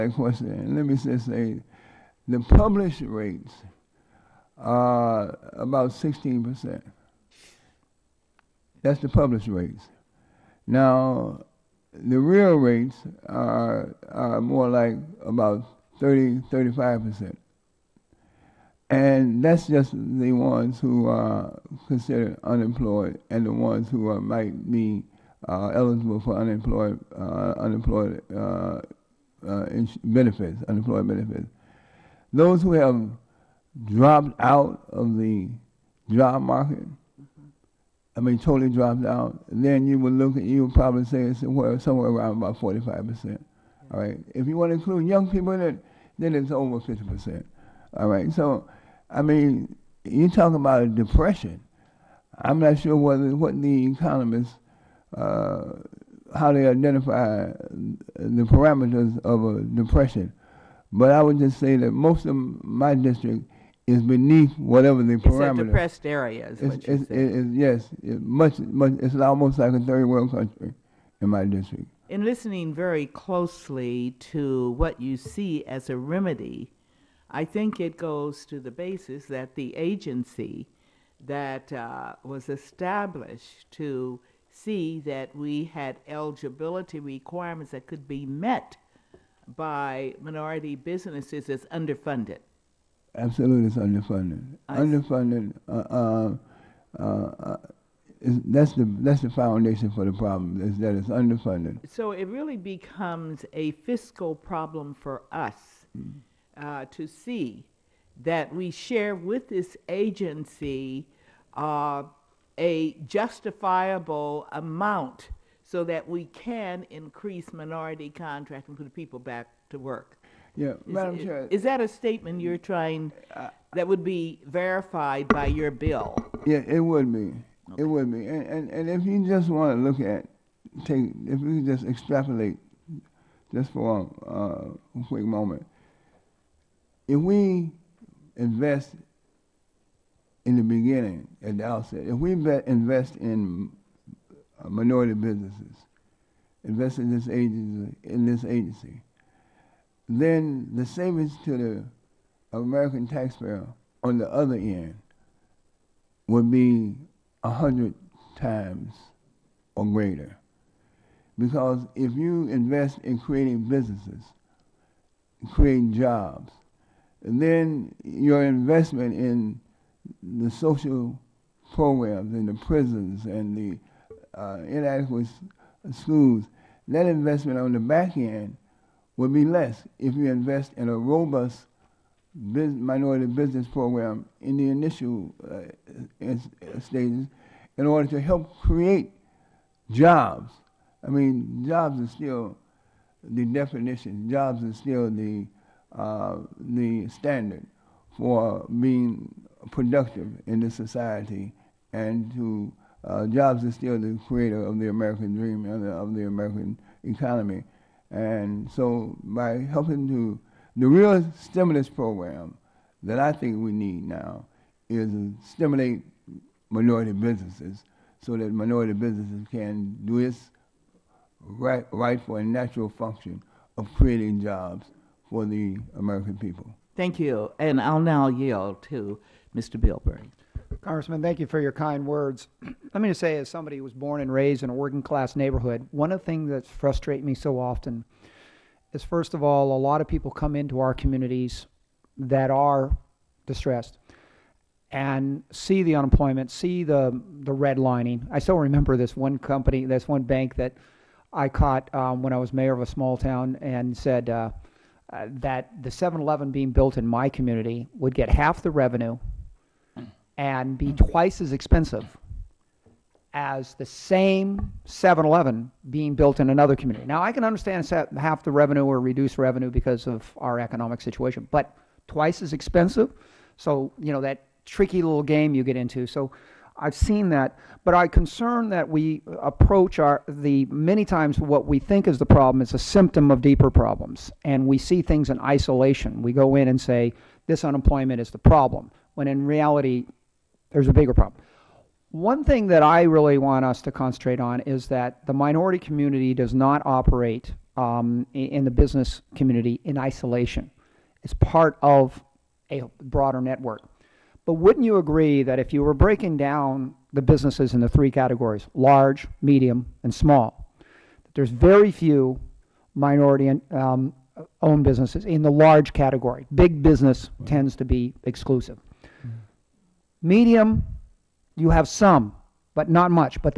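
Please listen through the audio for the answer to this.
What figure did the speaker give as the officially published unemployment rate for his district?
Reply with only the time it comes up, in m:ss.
0:05.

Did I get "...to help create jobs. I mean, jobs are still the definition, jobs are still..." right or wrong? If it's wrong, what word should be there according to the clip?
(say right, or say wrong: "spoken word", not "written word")
right.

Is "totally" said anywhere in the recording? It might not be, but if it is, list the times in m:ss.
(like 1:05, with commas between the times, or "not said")
0:38.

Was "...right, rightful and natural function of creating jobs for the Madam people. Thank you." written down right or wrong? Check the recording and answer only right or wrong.
wrong.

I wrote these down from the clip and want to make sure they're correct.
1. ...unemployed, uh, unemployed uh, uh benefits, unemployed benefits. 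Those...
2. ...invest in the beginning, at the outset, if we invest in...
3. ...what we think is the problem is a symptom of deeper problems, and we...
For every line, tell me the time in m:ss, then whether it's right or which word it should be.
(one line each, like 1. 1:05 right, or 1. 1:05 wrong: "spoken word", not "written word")
1. 0:26 right
2. 2:18 right
3. 4:41 right.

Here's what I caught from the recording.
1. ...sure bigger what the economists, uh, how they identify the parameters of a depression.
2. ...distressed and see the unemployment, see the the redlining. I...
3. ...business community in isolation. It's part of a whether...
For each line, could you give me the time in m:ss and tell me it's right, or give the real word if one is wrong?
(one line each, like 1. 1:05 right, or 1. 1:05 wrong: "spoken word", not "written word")
1. 0:52 wrong: "whether", not "bigger"
2. 4:03 right
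3. 4:58 wrong: "broader", not "whether".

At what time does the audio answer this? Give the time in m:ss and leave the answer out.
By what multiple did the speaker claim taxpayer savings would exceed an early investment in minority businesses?
2:37.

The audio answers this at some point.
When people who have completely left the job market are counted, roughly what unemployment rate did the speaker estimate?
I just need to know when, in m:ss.
0:42.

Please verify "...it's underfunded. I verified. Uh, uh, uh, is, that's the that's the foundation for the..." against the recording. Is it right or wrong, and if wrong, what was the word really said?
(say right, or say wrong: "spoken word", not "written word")
wrong: "underfunded", not "verified".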